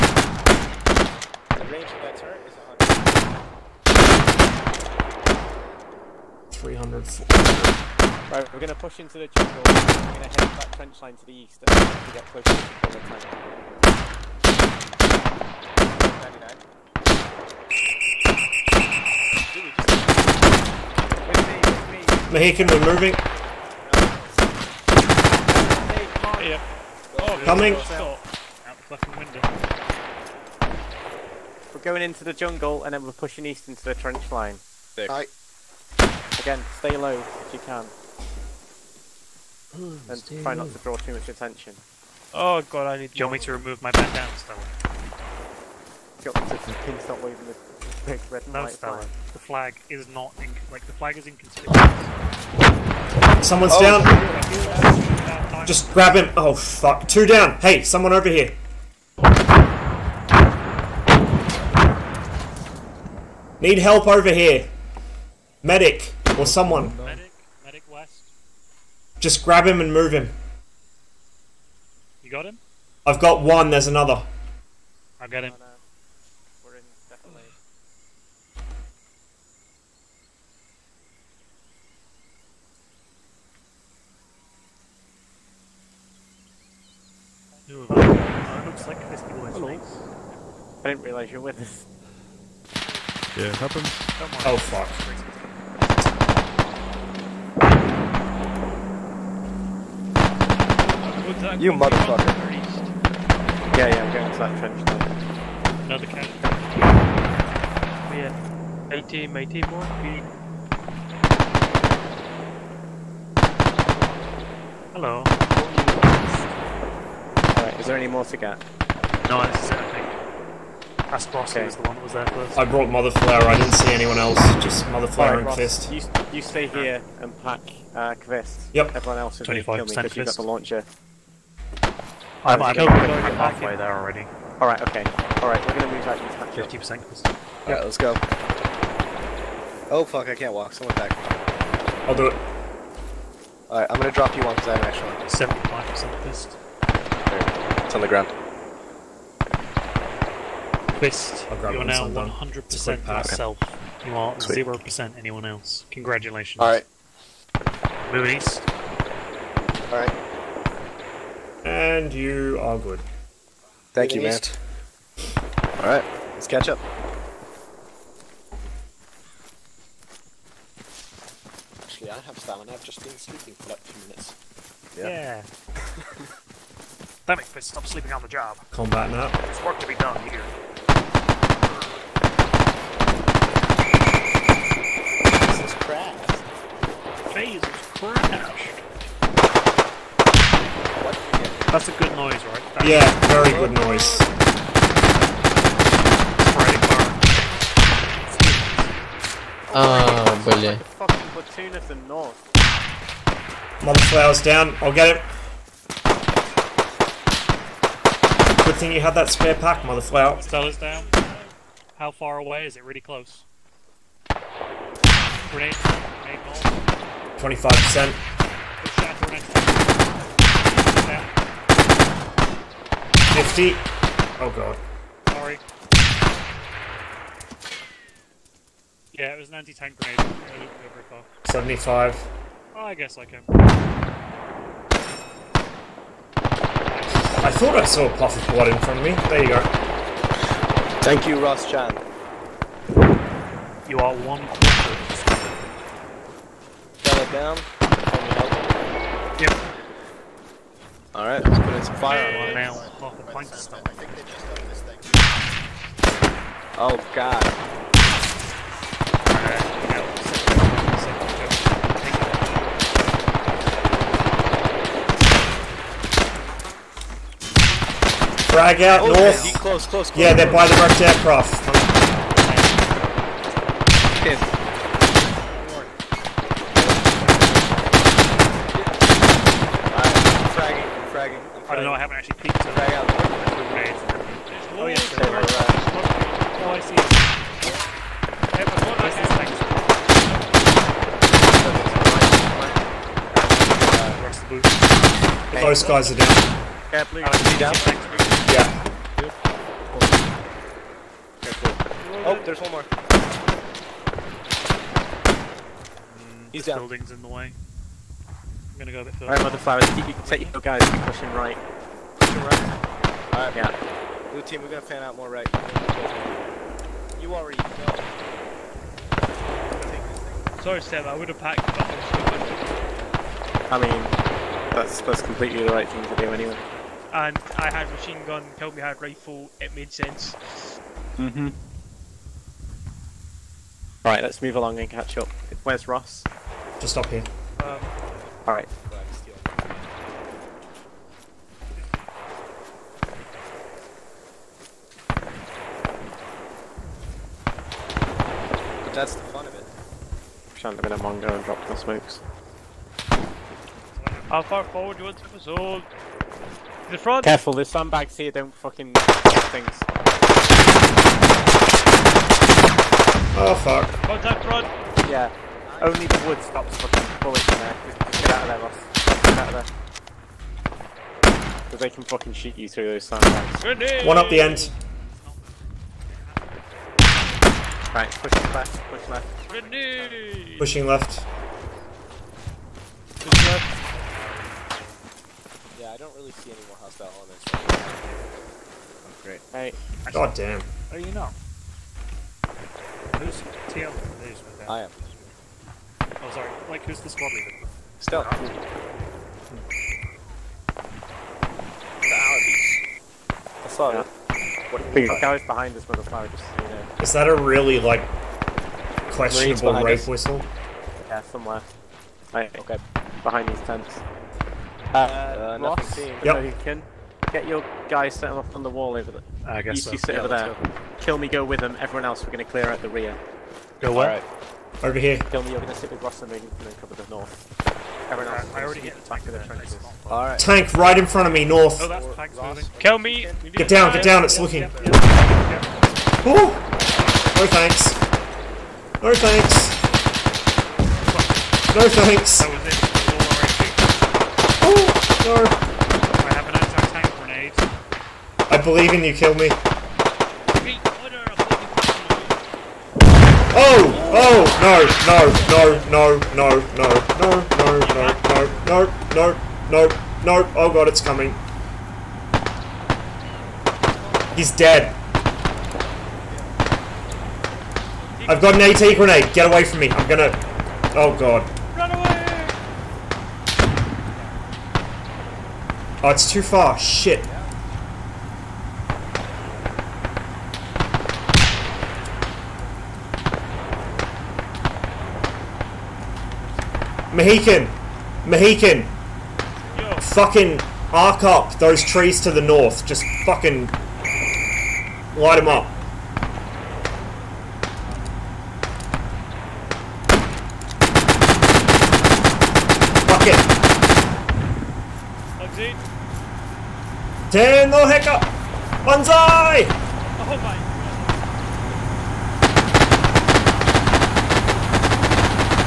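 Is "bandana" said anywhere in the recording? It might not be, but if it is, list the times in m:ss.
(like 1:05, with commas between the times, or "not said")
0:43.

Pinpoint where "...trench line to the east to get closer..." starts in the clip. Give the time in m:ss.
0:10.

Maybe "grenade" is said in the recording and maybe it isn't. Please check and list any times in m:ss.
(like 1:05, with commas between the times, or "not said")
3:35, 3:49, 6:19, 7:27, 7:48.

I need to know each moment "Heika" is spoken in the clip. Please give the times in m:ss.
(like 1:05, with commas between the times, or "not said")
8:27.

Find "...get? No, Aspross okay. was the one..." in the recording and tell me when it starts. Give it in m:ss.
1:58.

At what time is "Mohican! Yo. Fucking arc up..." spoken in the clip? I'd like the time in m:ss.
8:08.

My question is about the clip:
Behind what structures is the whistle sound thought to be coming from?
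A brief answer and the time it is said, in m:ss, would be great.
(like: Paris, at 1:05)
tents, at 6:53.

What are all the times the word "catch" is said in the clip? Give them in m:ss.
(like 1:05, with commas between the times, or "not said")
2:46, 5:34.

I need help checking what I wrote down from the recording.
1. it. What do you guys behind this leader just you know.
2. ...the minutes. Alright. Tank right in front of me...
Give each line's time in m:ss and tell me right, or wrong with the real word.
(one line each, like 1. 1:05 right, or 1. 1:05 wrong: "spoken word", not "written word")
1. 6:44 wrong: "motherfucker", not "leader"
2. 7:09 wrong: "trenches", not "minutes".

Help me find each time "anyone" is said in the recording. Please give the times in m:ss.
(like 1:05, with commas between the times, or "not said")
2:03, 2:35.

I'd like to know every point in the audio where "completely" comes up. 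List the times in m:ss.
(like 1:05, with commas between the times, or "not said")
5:25.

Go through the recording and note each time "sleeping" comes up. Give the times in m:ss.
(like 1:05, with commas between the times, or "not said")
2:53, 2:57.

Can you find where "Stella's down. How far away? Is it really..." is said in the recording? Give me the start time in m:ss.
3:30.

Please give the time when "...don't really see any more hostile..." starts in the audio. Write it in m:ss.
6:25.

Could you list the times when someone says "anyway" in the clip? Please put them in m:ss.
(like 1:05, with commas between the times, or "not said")
5:26.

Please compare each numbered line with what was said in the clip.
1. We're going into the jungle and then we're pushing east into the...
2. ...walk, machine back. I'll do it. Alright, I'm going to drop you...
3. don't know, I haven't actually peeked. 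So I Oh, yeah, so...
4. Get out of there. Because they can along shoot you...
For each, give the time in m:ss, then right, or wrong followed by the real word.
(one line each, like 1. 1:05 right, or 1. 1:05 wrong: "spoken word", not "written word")
1. 0:31 right
2. 2:20 wrong: "someone", not "machine"
3. 4:41 right
4. 6:09 wrong: "fucking", not "along".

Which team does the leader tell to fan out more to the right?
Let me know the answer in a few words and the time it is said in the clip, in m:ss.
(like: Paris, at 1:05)
Blue team, at 5:14.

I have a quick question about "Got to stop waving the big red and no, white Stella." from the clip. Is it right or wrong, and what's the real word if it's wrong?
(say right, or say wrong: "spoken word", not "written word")
right.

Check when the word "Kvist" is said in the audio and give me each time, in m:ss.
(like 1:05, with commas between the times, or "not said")
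2:08, 2:17, 2:26, 2:30.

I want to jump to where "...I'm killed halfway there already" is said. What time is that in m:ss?
2:12.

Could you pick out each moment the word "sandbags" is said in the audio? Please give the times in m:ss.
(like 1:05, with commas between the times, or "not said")
5:57, 6:13.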